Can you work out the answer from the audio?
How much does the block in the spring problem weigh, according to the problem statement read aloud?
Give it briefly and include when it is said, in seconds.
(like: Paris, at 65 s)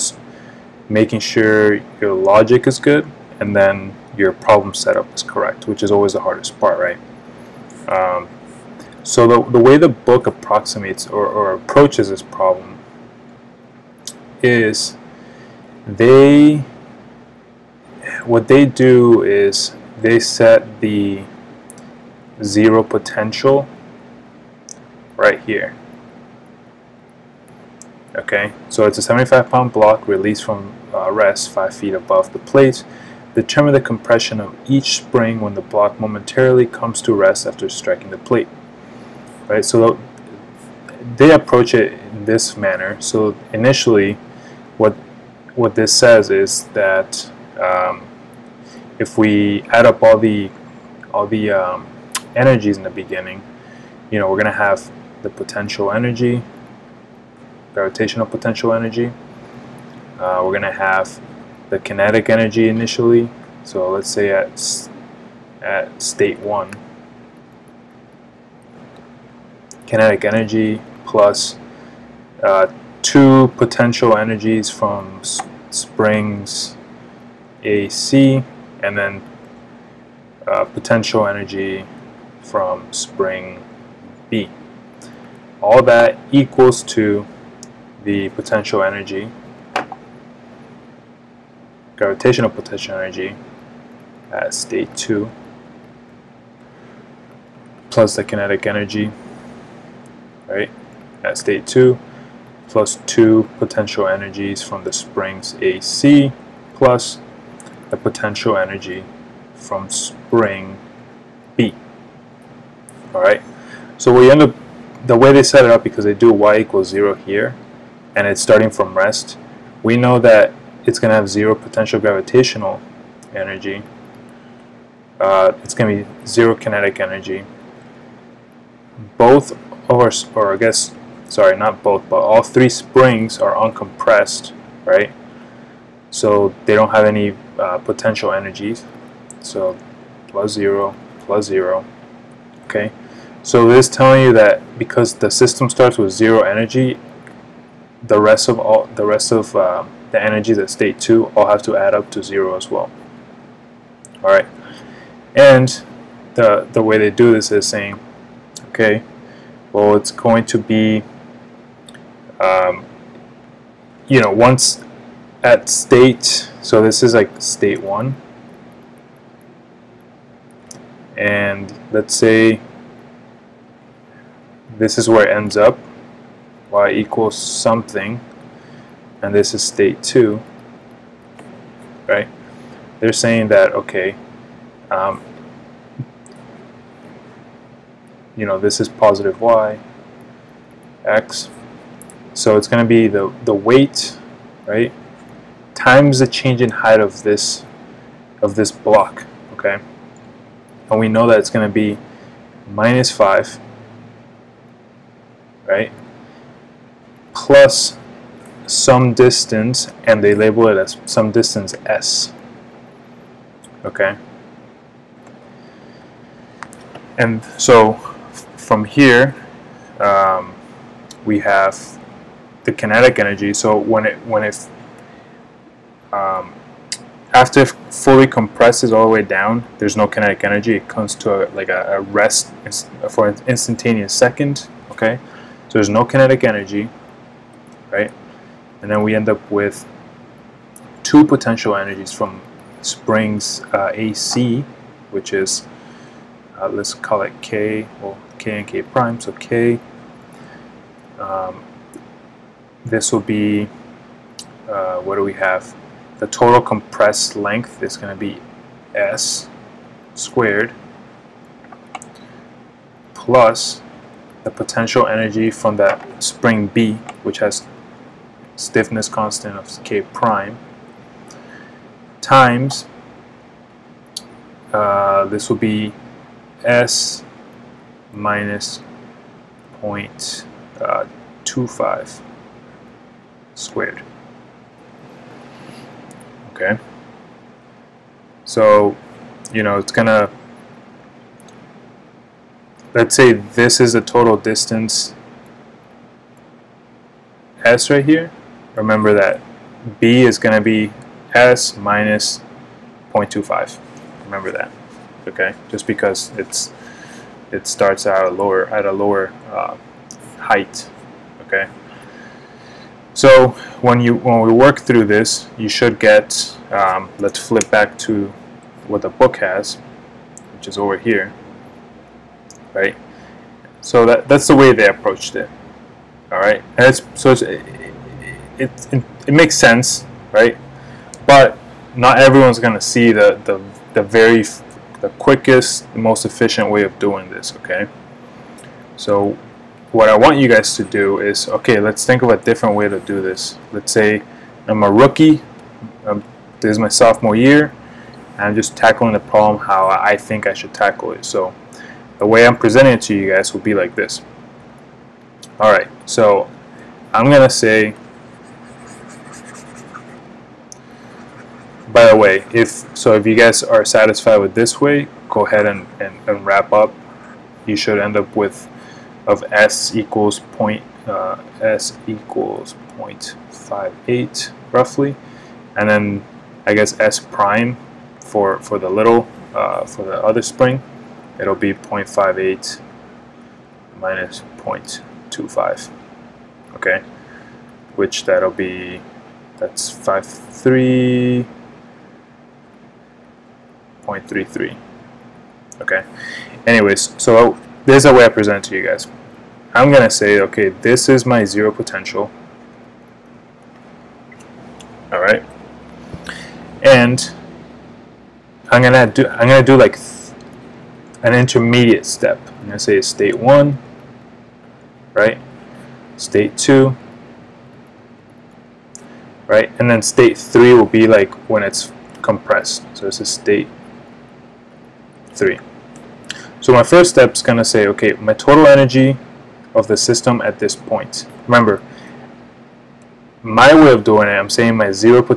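75 pounds, at 29 s.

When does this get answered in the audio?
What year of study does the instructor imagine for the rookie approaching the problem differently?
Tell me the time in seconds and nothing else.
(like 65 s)
346 s.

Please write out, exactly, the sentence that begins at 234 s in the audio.
Okay, so there's no kinetic energy, right?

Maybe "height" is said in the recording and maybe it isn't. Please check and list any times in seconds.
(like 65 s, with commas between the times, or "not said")
196 s, 310 s.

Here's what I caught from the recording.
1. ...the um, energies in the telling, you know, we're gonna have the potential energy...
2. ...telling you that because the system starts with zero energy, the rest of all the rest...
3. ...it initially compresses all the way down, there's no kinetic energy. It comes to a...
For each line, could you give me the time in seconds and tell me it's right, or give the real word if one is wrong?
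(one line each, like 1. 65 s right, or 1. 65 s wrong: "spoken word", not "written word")
1. 51 s wrong: "beginning", not "telling"
2. 143 s right
3. 227 s wrong: "fully", not "initially".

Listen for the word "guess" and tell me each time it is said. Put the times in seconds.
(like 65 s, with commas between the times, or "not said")
130 s, 376 s.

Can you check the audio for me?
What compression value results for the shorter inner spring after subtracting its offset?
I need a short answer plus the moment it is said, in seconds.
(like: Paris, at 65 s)
0.33, at 394 s.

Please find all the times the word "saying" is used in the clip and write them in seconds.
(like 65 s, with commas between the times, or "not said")
157 s, 183 s, 434 s.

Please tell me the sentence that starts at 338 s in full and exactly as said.
So what I want you guys to do is, okay, let's think of a different way to do this.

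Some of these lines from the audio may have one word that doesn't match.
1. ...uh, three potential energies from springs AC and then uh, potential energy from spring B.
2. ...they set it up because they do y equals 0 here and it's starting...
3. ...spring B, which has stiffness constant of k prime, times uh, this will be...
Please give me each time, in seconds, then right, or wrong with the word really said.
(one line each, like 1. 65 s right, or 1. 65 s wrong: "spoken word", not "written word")
1. 72 s wrong: "two", not "three"
2. 115 s right
3. 266 s right.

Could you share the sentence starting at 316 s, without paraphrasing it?
Um, let's flip back to what the book has, which is over here, right?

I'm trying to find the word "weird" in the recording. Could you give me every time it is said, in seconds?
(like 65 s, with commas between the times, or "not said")
not said.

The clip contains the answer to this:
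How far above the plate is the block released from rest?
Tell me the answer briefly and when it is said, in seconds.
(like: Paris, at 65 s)
5 feet, at 31 s.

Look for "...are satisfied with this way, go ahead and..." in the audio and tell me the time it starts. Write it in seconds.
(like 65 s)
363 s.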